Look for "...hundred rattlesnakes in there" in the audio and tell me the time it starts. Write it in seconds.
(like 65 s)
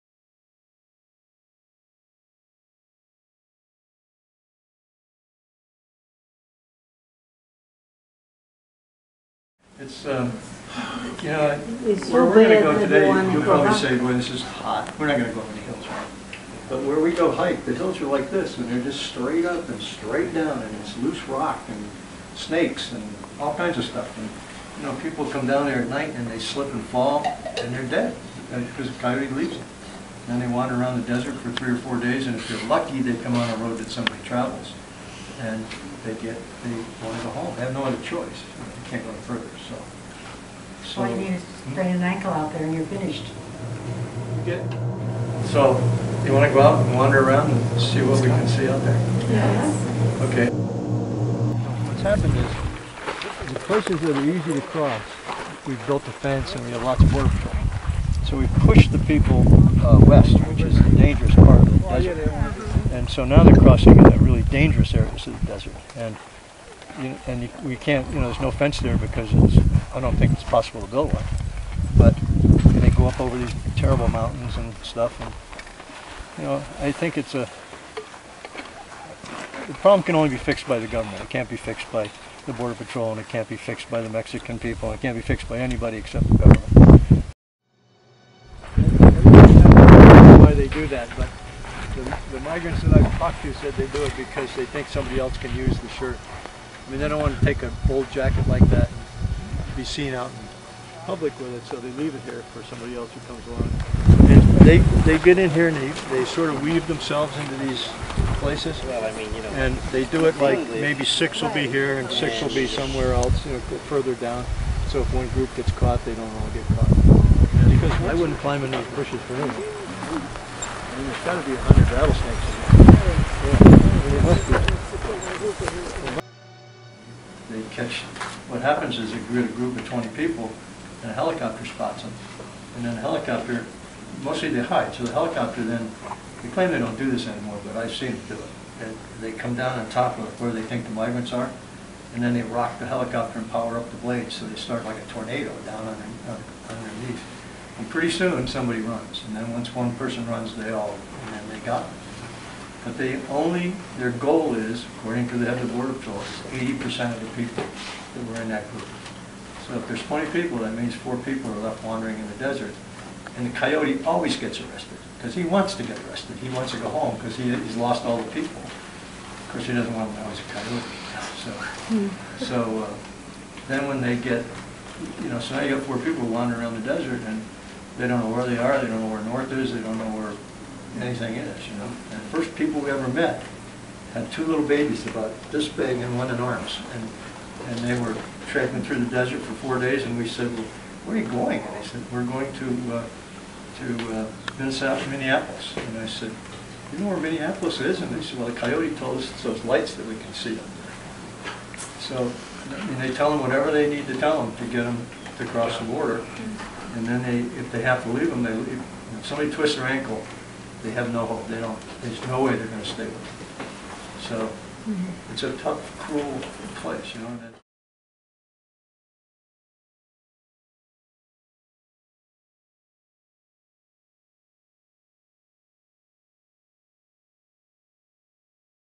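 121 s.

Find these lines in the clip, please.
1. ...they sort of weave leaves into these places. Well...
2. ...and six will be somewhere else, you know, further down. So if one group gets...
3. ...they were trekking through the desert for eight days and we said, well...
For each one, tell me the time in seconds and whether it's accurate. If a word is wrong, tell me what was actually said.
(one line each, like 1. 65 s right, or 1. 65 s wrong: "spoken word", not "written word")
1. 106 s wrong: "themselves", not "leaves"
2. 111 s right
3. 187 s wrong: "four", not "eight".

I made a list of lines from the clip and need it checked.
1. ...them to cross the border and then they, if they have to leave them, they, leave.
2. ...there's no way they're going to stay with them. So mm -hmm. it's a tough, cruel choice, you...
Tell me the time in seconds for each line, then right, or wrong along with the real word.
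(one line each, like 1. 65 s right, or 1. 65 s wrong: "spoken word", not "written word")
1. 204 s right
2. 212 s wrong: "place", not "choice".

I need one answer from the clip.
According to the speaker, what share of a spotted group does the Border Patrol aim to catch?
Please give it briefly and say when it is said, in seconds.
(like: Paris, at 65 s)
80%, at 155 s.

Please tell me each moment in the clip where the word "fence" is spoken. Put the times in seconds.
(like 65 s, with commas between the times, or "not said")
56 s, 68 s.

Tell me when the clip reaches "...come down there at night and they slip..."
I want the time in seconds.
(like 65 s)
25 s.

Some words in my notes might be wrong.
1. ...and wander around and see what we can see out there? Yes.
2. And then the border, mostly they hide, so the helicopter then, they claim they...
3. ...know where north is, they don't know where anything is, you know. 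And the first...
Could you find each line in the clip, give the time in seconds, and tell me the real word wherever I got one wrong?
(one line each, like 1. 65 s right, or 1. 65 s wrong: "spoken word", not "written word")
1. 46 s right
2. 132 s wrong: "helicopter", not "border"
3. 178 s right.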